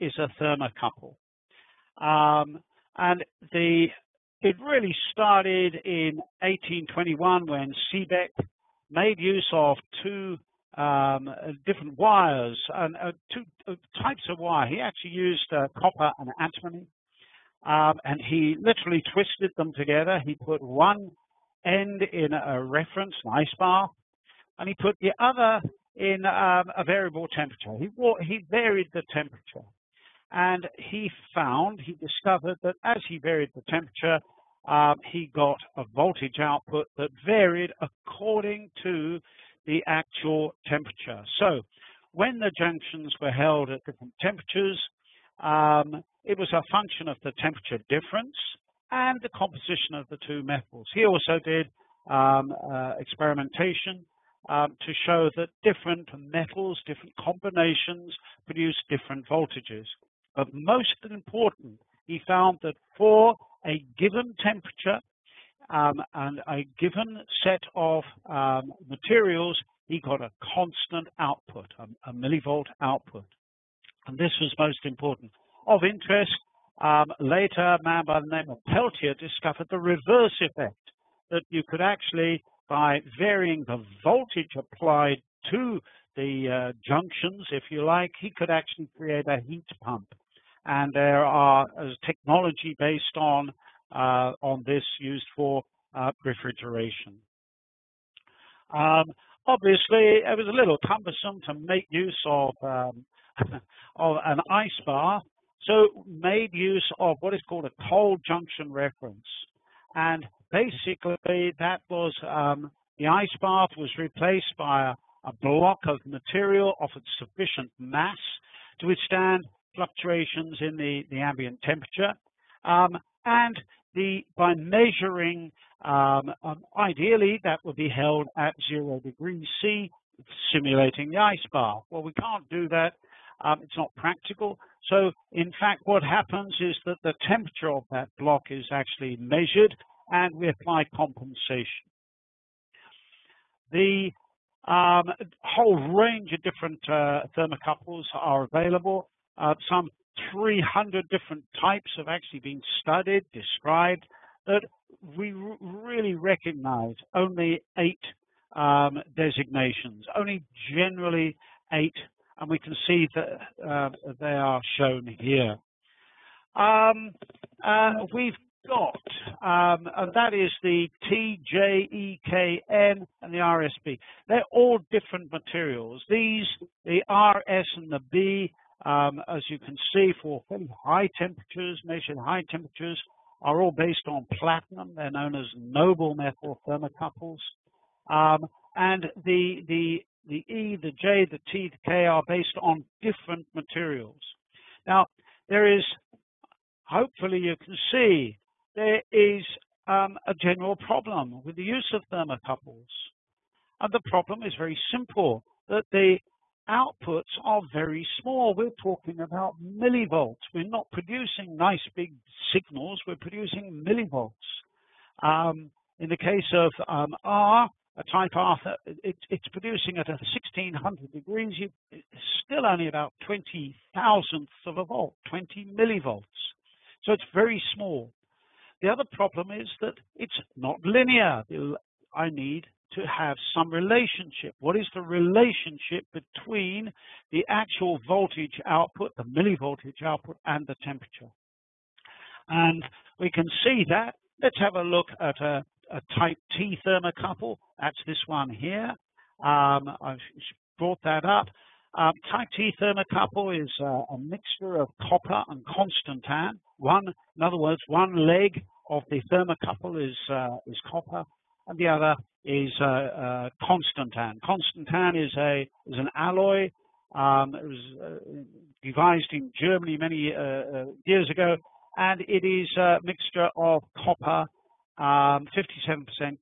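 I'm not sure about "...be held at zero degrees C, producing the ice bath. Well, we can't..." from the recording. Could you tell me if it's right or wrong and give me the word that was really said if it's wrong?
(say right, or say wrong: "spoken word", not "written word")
wrong: "simulating", not "producing".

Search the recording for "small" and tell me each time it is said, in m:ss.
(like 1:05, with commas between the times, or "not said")
3:28, 3:47.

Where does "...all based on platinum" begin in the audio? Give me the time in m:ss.
3:03.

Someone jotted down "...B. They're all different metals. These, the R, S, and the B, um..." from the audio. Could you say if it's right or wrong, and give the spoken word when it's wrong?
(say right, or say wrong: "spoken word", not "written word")
wrong: "materials", not "metals".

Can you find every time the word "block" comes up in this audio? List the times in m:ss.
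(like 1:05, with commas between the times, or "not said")
1:55, 2:18.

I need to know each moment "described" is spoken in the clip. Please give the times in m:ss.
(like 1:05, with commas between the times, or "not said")
2:33.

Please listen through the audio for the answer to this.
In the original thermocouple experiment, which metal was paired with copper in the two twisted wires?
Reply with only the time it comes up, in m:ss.
0:16.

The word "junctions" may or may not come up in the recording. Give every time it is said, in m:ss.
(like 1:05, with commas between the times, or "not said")
0:42, 1:26, 1:48.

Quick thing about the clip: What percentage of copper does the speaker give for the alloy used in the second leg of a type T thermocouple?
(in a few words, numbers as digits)
57%.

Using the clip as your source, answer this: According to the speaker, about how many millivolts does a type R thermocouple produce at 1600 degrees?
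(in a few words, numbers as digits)
20 millivolts.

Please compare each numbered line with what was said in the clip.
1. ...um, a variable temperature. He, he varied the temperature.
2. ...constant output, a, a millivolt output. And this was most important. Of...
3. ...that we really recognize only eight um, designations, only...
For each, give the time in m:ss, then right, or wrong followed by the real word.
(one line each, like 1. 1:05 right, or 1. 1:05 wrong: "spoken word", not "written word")
1. 0:26 right
2. 1:10 right
3. 2:34 right.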